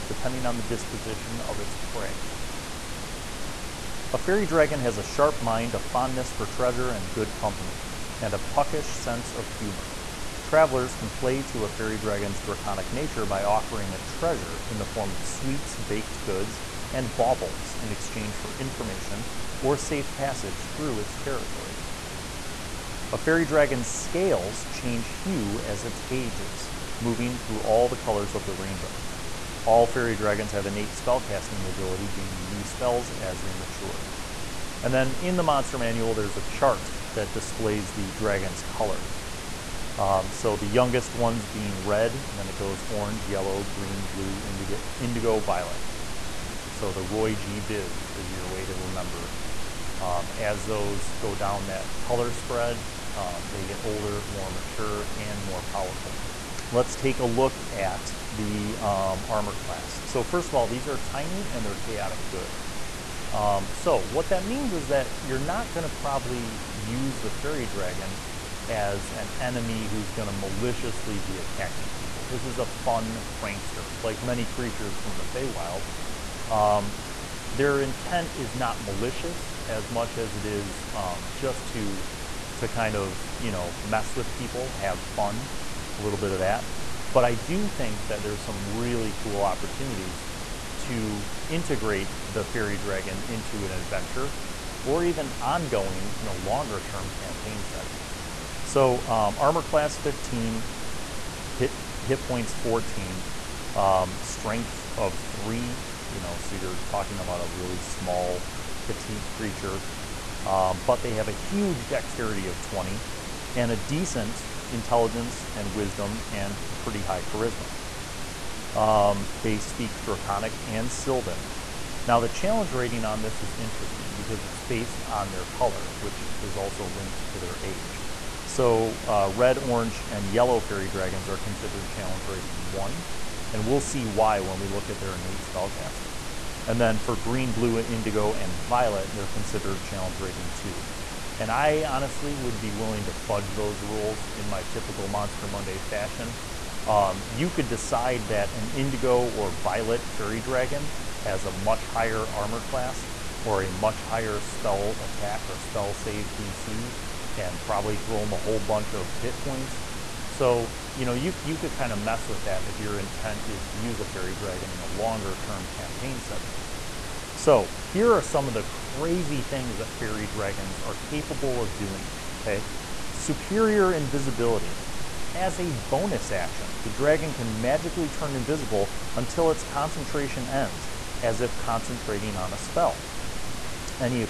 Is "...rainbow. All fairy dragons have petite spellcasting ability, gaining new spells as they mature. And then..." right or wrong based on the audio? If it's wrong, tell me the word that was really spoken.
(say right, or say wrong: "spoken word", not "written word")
wrong: "innate", not "petite".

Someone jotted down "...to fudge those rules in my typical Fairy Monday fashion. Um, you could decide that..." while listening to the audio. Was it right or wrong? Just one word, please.
wrong.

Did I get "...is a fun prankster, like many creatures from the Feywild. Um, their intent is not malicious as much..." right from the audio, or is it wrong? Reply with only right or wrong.
right.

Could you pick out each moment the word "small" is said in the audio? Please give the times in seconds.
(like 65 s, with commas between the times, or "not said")
107 s.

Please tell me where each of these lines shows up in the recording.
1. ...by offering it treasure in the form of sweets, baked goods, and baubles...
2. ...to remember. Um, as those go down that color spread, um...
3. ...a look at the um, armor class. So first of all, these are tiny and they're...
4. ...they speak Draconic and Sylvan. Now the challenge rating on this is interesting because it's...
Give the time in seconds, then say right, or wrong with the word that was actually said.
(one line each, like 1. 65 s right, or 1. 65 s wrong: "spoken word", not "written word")
1. 13 s right
2. 48 s right
3. 57 s right
4. 119 s right.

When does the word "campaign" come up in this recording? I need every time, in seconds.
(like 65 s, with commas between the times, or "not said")
97 s, 165 s.